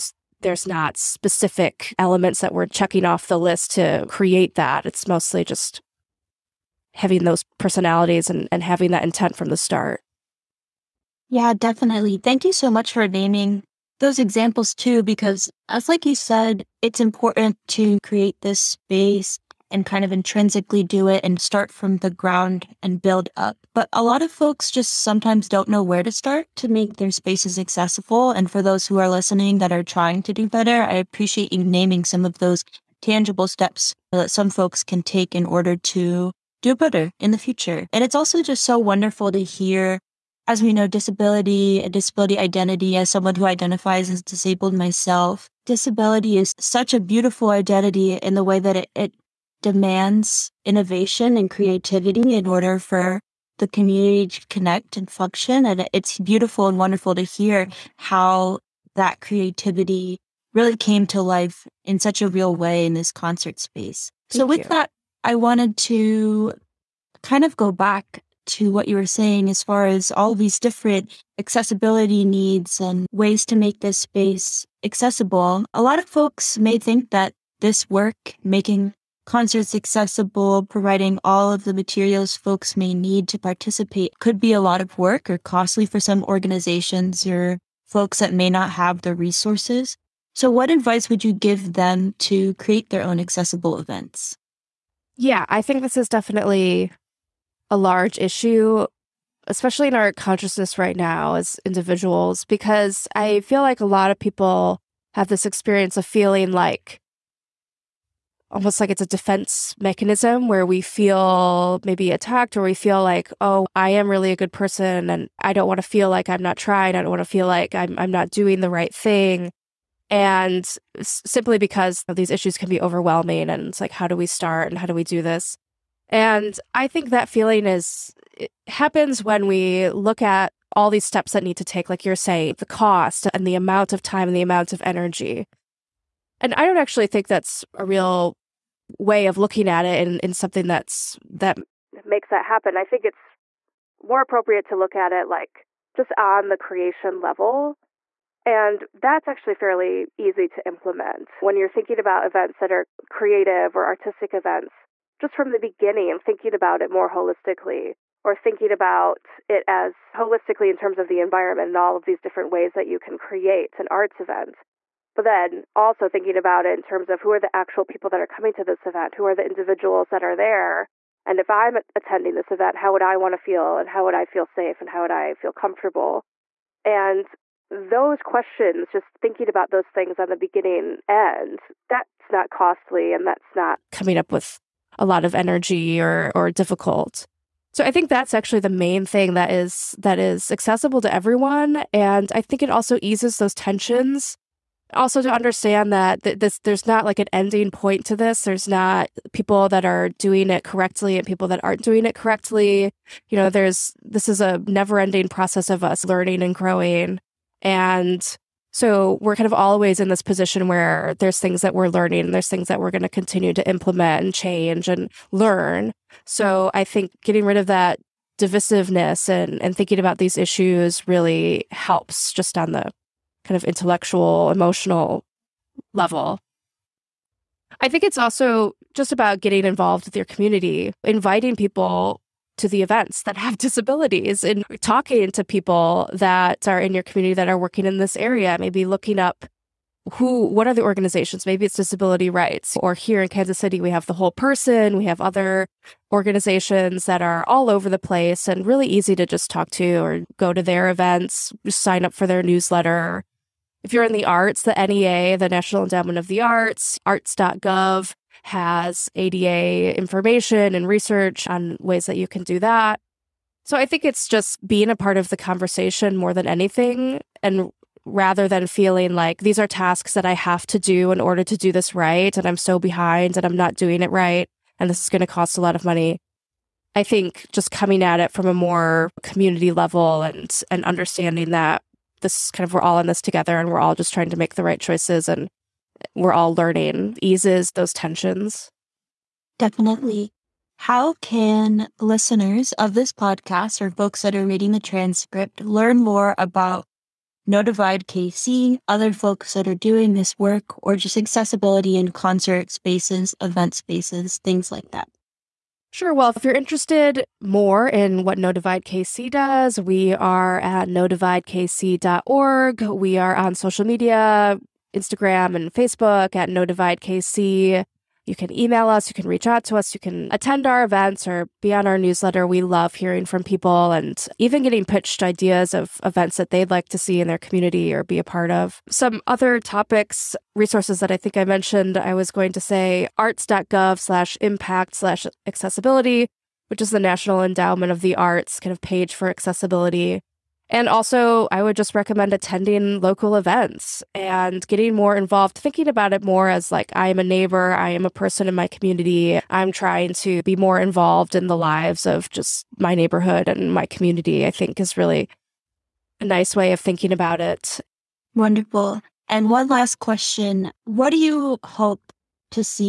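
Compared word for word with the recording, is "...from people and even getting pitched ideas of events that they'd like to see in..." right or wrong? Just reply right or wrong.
right.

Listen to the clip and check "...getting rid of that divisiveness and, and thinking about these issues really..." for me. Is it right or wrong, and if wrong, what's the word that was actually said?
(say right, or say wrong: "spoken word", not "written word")
right.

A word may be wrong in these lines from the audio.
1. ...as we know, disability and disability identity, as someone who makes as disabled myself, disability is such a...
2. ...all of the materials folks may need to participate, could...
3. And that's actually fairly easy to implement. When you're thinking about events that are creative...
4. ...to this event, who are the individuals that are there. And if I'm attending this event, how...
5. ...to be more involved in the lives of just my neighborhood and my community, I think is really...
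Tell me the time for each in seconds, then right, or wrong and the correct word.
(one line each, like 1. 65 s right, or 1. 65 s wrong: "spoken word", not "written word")
1. 40 s wrong: "identifies", not "makes"
2. 81 s right
3. 148 s right
4. 168 s right
5. 350 s right.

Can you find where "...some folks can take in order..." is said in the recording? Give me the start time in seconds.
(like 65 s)
34 s.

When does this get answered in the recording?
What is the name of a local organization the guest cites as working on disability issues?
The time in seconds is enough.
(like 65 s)
244 s.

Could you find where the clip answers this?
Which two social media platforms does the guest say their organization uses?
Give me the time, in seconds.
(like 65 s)
314 s.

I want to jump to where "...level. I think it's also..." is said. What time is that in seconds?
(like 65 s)
225 s.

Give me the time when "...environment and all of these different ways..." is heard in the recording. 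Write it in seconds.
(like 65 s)
161 s.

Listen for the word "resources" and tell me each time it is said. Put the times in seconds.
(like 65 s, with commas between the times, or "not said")
89 s, 330 s.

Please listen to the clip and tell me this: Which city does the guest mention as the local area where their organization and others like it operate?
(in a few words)
Kansas City.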